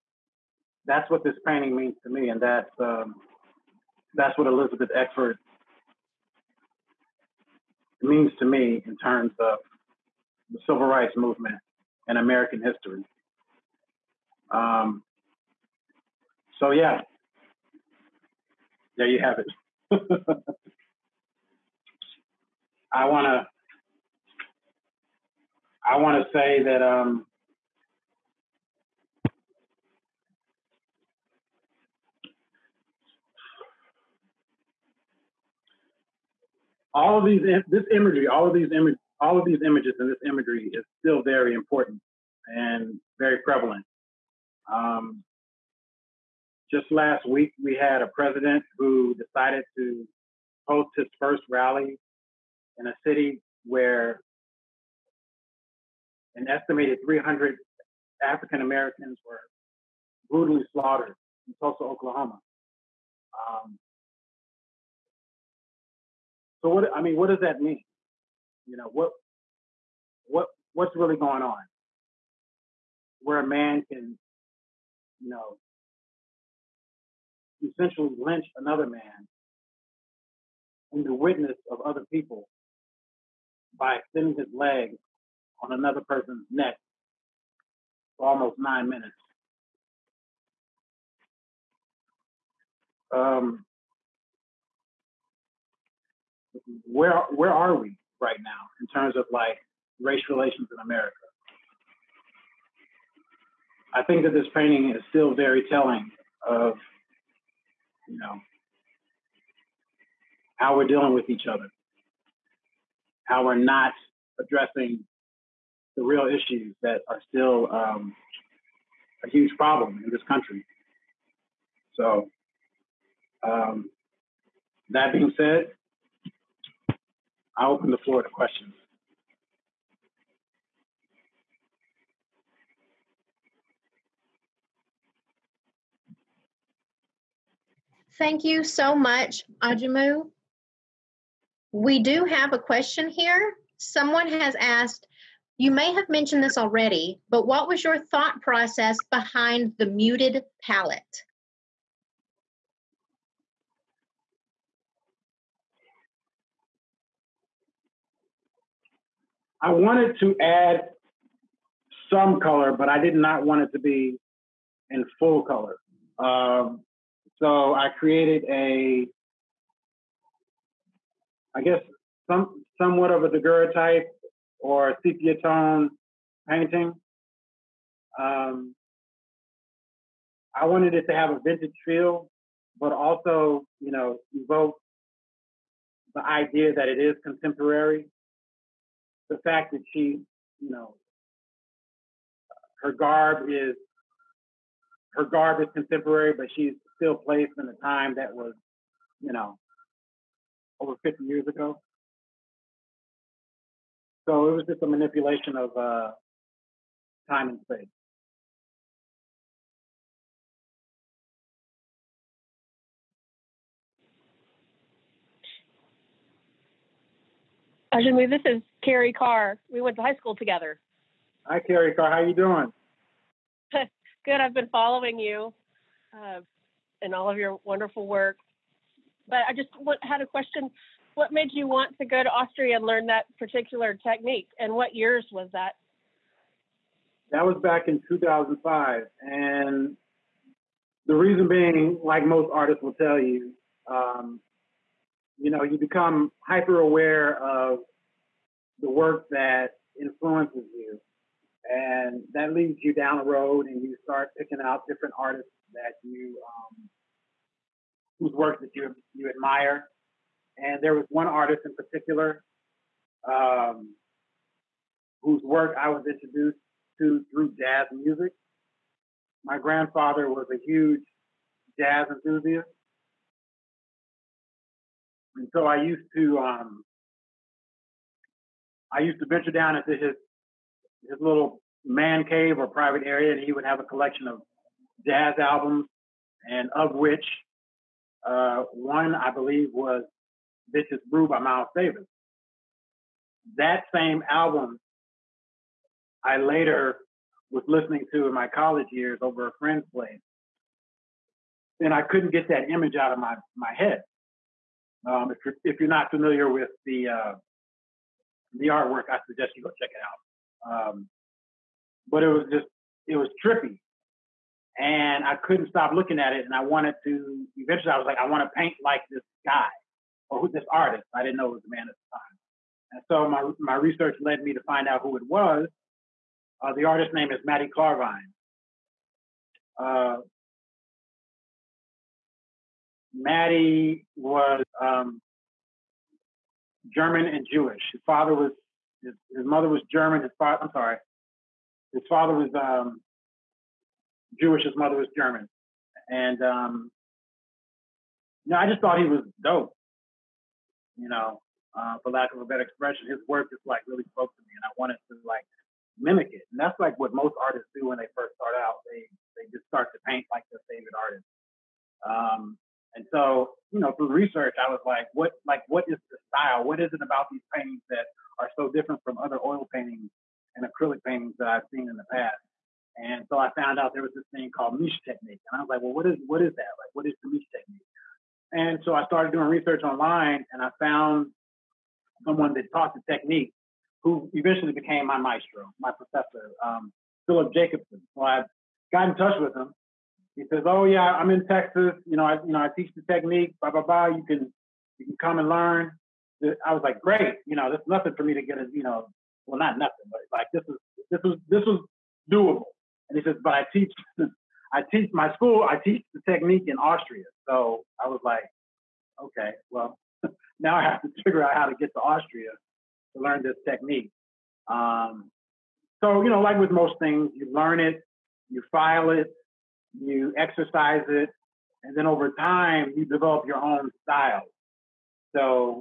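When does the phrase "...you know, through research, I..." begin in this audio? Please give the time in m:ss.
6:03.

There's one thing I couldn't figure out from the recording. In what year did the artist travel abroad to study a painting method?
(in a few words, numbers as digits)
2005.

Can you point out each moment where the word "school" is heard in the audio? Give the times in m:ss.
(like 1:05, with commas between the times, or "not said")
3:40, 6:45.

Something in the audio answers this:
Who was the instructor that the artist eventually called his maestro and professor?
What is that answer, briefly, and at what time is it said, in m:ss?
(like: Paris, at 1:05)
Philip Jacobson, at 6:27.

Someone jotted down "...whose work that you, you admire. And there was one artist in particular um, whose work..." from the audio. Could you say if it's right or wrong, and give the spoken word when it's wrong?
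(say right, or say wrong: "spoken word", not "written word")
right.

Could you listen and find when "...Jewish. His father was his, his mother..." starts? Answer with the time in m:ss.
5:37.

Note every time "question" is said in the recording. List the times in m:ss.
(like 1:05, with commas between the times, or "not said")
2:08, 2:22, 3:50.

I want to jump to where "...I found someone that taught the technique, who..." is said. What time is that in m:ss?
6:20.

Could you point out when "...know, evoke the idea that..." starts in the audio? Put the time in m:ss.
3:03.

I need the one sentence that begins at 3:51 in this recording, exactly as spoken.
What made you want to go to Austria and learn that particular technique?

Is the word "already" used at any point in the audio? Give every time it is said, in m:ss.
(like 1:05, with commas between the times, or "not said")
2:26.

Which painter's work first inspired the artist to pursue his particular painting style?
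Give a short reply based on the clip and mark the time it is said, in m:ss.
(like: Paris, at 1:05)
Mati Klarwein, at 5:27.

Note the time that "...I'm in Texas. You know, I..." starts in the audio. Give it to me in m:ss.
6:31.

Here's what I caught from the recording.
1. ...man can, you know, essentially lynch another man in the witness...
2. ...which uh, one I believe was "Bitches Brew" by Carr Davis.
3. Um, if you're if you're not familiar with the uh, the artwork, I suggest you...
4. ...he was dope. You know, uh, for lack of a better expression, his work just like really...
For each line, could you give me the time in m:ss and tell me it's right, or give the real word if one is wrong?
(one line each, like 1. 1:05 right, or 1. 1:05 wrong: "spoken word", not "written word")
1. 1:13 right
2. 4:46 wrong: "Miles", not "Carr"
3. 5:05 right
4. 5:49 right.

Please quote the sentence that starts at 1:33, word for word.
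Um, where where are we right now in terms of like race relations in America?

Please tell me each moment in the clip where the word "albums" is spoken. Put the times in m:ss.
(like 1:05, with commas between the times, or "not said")
4:45, 4:54.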